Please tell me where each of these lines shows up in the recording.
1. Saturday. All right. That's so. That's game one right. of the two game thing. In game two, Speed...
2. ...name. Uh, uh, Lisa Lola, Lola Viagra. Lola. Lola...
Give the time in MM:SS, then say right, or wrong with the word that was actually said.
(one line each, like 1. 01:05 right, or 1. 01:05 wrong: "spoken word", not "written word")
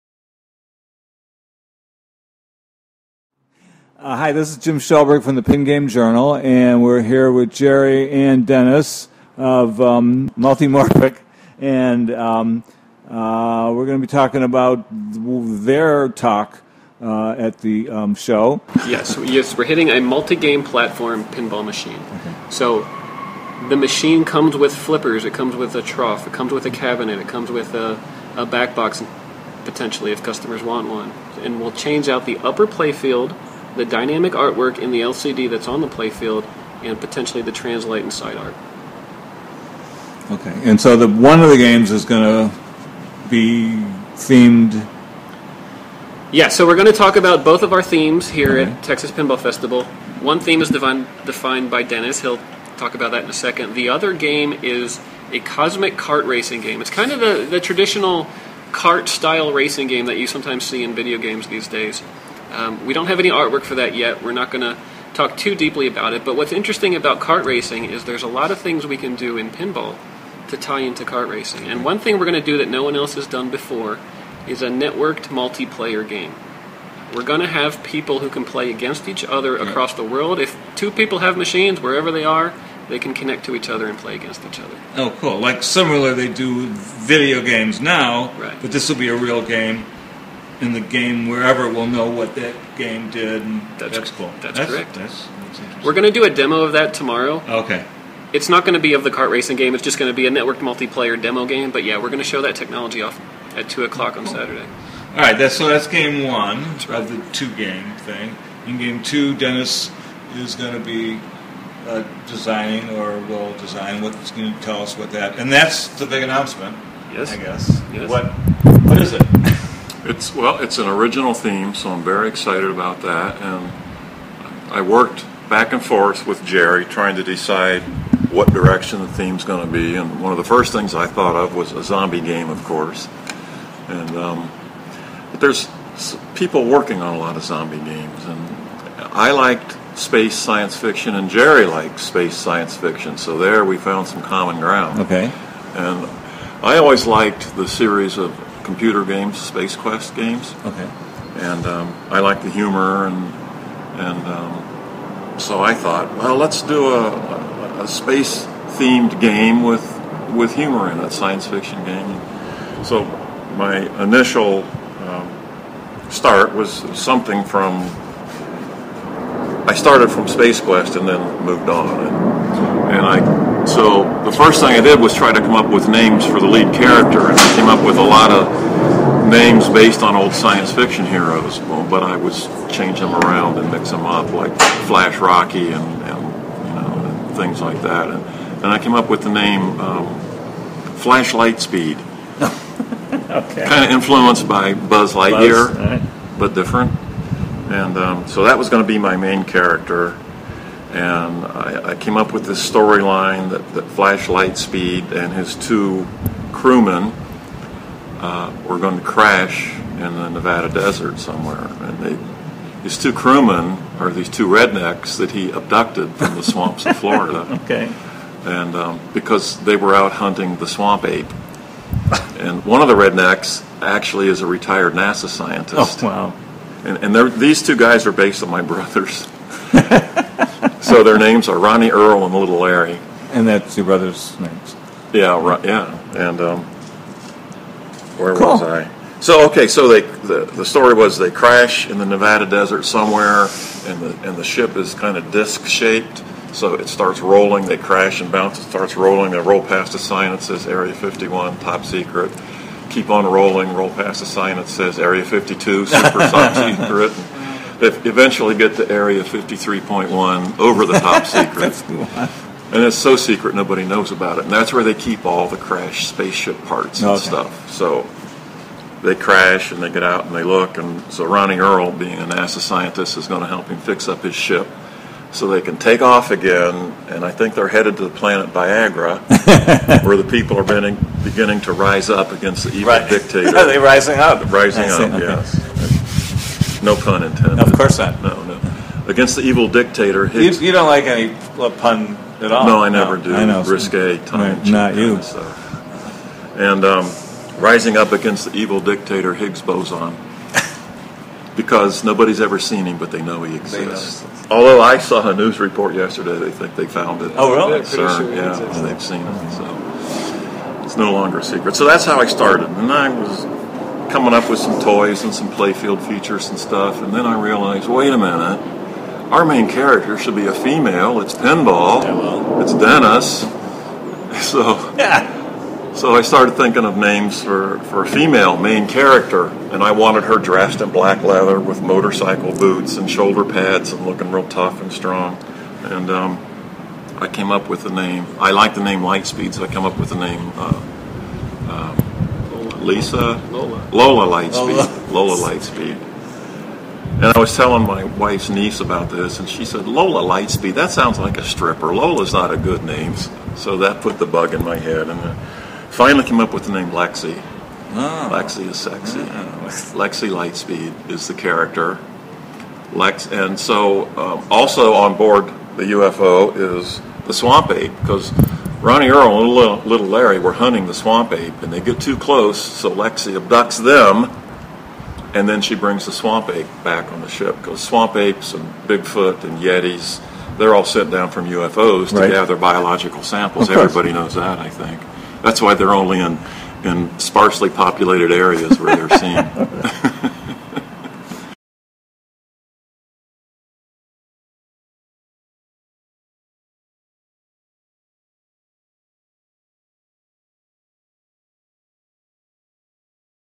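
1. 01:44 wrong: "Dennis", not "Speed"
2. 05:40 wrong: "Lightspeed", not "Viagra".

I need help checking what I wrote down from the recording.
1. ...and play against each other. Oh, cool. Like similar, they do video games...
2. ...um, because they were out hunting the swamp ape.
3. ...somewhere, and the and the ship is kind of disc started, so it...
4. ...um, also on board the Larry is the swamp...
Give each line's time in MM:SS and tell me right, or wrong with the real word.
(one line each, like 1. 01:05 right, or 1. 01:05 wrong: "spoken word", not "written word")
1. 01:23 right
2. 03:38 right
3. 04:02 wrong: "shaped", not "started"
4. 06:04 wrong: "UFO", not "Larry".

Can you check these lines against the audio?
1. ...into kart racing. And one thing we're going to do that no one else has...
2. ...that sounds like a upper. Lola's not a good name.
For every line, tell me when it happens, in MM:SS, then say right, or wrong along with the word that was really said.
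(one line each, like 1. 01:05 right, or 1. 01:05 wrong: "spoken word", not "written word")
1. 01:10 right
2. 05:50 wrong: "stripper", not "upper".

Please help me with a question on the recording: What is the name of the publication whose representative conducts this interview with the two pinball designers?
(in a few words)
Pin Game Journal.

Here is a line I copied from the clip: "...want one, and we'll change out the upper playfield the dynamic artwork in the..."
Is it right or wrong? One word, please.
right.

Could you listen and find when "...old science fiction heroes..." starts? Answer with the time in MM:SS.
03:00.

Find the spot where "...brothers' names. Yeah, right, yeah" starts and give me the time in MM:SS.
03:53.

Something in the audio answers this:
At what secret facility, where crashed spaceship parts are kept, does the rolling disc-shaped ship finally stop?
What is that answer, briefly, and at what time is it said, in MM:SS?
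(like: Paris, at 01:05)
Area 53.1, at 04:18.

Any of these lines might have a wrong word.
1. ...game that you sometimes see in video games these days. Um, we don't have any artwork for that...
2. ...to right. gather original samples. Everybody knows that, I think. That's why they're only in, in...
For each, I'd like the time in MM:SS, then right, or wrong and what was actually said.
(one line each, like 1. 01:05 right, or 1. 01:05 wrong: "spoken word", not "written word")
1. 00:59 right
2. 06:22 wrong: "biological", not "original".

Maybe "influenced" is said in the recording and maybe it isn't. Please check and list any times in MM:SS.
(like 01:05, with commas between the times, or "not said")
03:13.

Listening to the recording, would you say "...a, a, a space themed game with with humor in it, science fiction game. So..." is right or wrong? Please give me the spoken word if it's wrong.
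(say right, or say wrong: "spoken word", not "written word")
right.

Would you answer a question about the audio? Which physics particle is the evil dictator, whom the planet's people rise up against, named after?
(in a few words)
Higgs boson.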